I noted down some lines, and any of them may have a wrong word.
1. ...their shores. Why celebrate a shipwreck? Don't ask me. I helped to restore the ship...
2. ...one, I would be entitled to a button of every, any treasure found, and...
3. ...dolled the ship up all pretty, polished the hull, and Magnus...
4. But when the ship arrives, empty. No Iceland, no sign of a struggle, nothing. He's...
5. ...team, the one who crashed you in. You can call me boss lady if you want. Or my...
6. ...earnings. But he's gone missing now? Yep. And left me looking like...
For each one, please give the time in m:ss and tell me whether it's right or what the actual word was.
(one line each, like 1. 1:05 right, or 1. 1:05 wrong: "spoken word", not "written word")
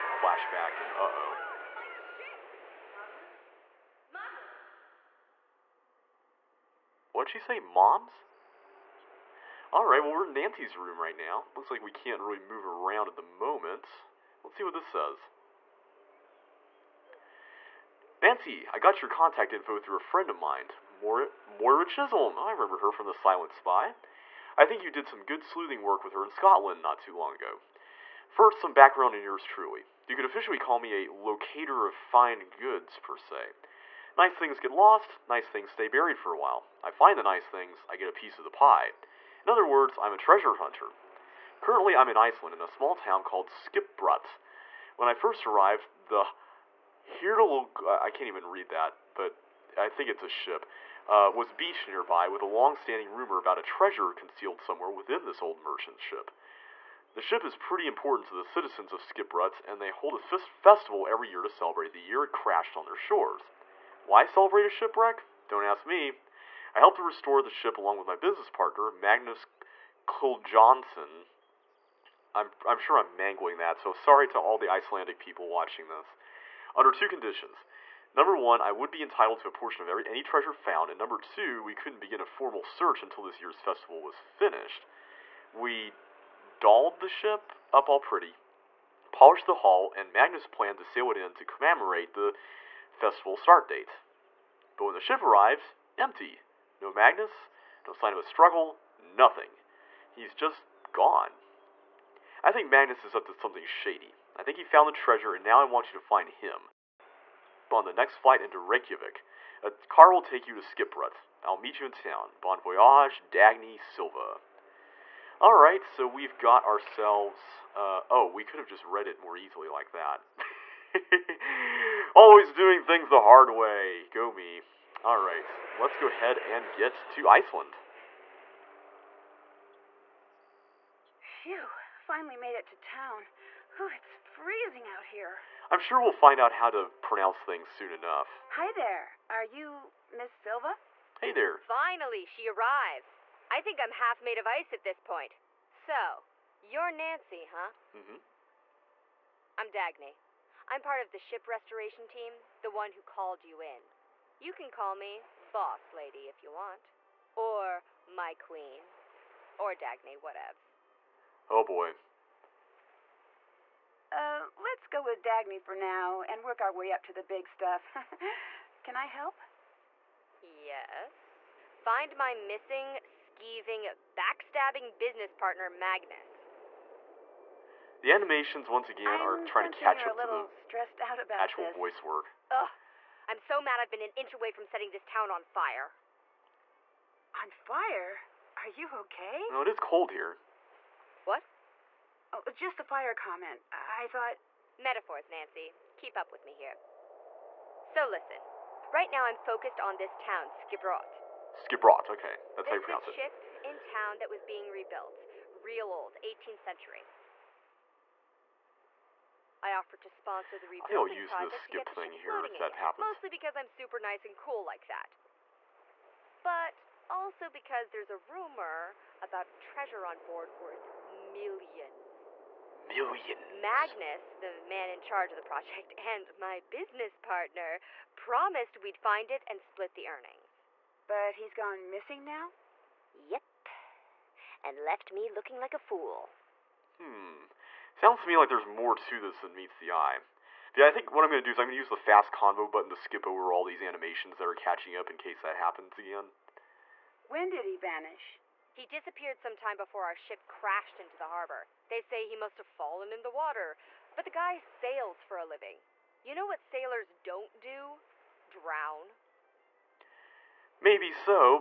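1. 1:02 right
2. 1:18 wrong: "portion", not "button"
3. 1:26 right
4. 1:34 wrong: "Magnus", not "Iceland"
5. 2:32 wrong: "called", not "crashed"
6. 3:50 right.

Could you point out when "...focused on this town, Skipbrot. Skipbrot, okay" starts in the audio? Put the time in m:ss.
3:19.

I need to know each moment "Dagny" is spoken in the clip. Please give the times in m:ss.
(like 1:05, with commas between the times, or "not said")
1:53, 2:29, 2:39, 2:45.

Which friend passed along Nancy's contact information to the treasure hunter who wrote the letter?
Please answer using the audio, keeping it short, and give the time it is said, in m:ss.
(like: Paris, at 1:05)
Moira Chisholm, at 0:21.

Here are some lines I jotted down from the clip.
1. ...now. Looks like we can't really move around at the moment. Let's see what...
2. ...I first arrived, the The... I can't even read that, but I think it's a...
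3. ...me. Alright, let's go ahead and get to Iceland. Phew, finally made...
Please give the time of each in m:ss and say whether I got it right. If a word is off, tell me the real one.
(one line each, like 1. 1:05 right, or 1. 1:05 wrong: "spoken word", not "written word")
1. 0:11 right
2. 0:45 wrong: "Hirtle", not "The"
3. 2:04 right.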